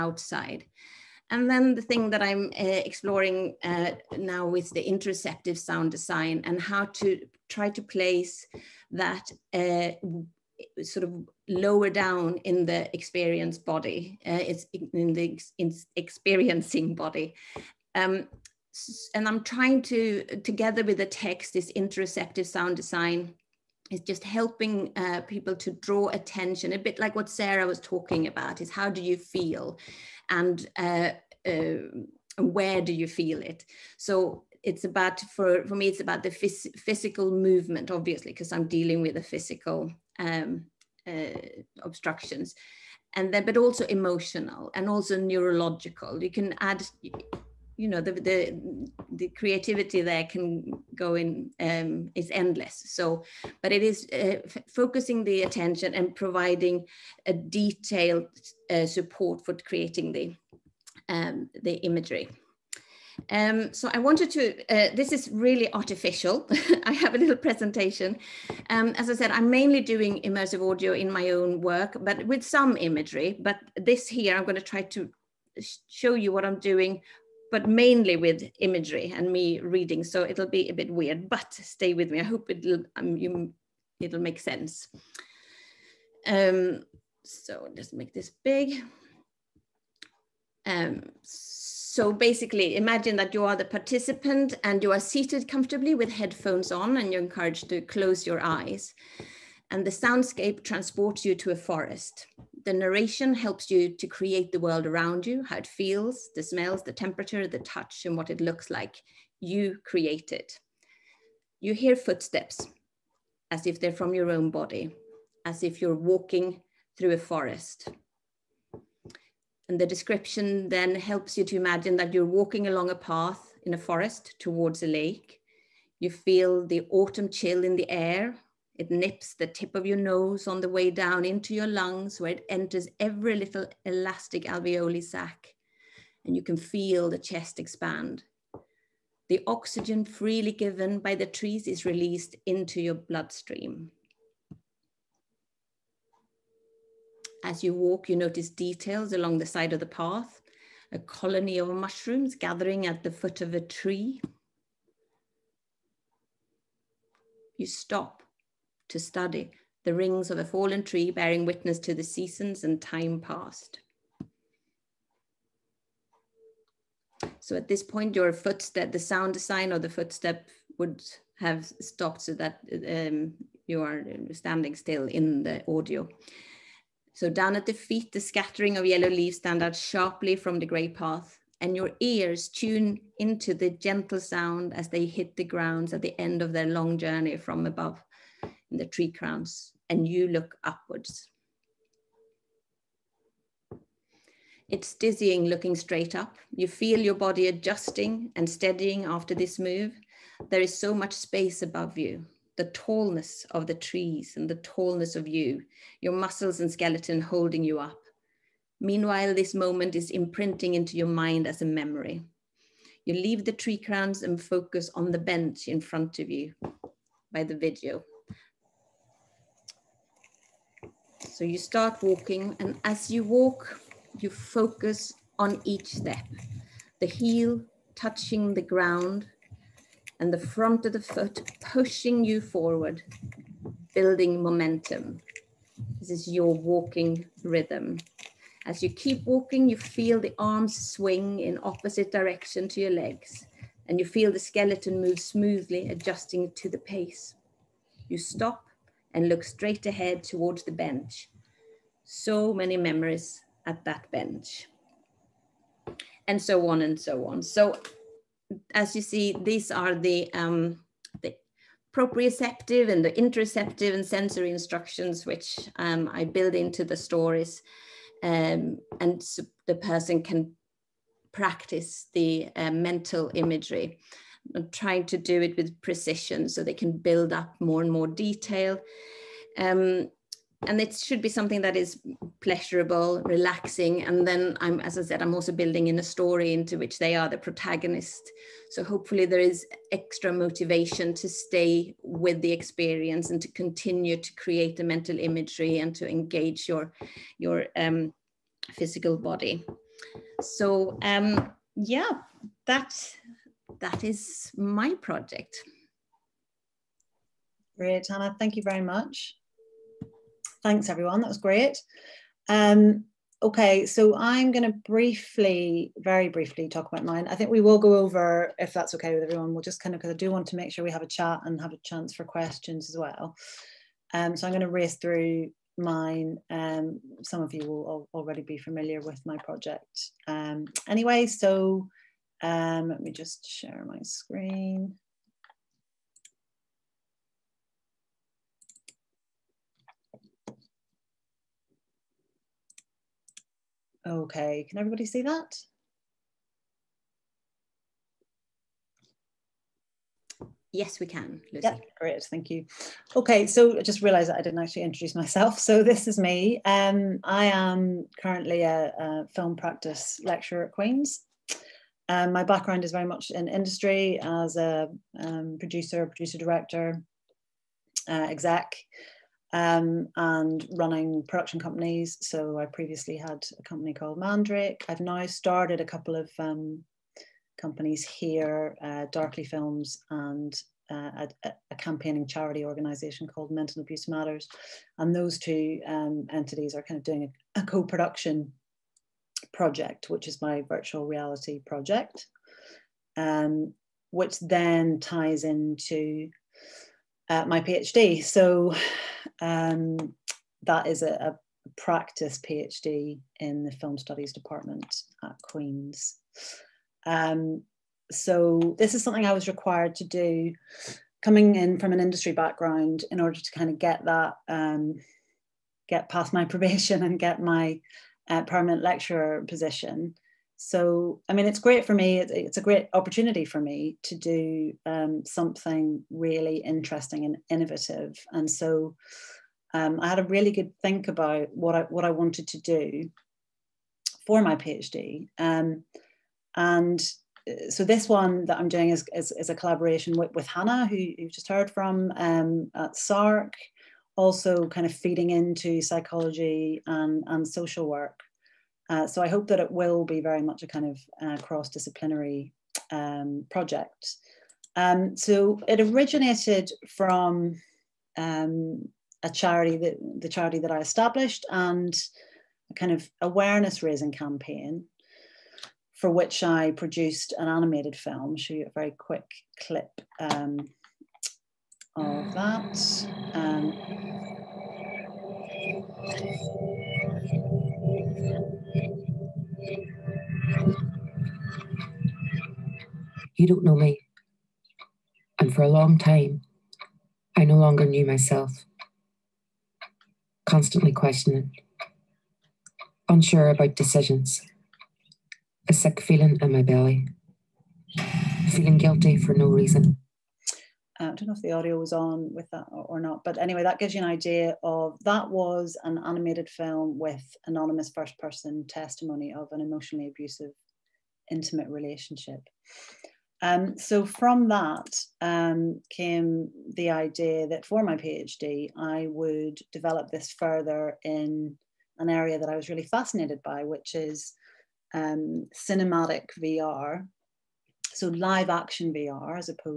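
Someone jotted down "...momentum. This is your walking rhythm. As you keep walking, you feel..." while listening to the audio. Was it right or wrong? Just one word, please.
right.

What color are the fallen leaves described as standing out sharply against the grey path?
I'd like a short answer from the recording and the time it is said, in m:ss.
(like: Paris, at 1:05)
yellow, at 2:58.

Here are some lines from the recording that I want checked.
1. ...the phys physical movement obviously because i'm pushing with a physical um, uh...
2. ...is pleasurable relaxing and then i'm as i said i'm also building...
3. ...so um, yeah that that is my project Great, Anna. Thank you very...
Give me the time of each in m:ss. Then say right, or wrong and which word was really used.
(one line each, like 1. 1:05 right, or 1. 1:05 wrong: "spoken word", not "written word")
1. 0:36 wrong: "dealing", not "pushing"
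2. 4:41 right
3. 5:00 right.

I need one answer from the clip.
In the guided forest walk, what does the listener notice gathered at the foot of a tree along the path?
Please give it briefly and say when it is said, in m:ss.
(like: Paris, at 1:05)
a colony of mushrooms, at 2:30.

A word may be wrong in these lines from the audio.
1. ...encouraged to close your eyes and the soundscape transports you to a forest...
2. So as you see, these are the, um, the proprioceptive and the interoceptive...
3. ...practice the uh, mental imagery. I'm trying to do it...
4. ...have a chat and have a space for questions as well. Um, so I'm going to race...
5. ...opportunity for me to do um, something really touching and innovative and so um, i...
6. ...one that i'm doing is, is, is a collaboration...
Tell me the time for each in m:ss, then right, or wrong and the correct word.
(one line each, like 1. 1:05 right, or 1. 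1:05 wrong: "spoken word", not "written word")
1. 1:37 right
2. 4:17 right
3. 4:31 right
4. 5:20 wrong: "chance", not "space"
5. 7:02 wrong: "interesting", not "touching"
6. 7:18 right.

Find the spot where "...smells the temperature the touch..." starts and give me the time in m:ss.
1:46.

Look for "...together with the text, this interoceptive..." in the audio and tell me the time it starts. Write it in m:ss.
0:20.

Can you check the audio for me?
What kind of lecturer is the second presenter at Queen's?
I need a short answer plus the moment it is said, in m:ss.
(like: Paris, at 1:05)
film practice lecturer, at 5:59.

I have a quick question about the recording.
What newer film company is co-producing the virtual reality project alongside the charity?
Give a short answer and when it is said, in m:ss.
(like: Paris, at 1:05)
Darkly Films, at 6:19.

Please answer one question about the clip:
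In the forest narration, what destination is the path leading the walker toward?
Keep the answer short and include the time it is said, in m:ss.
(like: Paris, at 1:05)
a lake, at 2:04.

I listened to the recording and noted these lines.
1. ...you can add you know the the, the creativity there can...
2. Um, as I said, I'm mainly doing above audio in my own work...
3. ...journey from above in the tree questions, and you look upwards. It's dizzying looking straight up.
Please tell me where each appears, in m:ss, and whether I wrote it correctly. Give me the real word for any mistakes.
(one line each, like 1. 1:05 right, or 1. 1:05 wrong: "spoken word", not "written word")
1. 0:46 right
2. 1:08 wrong: "immersive", not "above"
3. 3:06 wrong: "crowns", not "questions".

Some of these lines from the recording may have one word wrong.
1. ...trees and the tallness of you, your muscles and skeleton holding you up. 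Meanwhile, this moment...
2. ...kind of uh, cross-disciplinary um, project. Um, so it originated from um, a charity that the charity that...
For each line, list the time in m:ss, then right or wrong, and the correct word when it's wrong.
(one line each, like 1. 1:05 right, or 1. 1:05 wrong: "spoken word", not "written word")
1. 3:23 right
2. 7:30 right.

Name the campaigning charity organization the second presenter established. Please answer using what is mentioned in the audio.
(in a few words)
Mental Abuse Matters.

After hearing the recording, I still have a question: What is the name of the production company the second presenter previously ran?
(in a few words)
Mandrake.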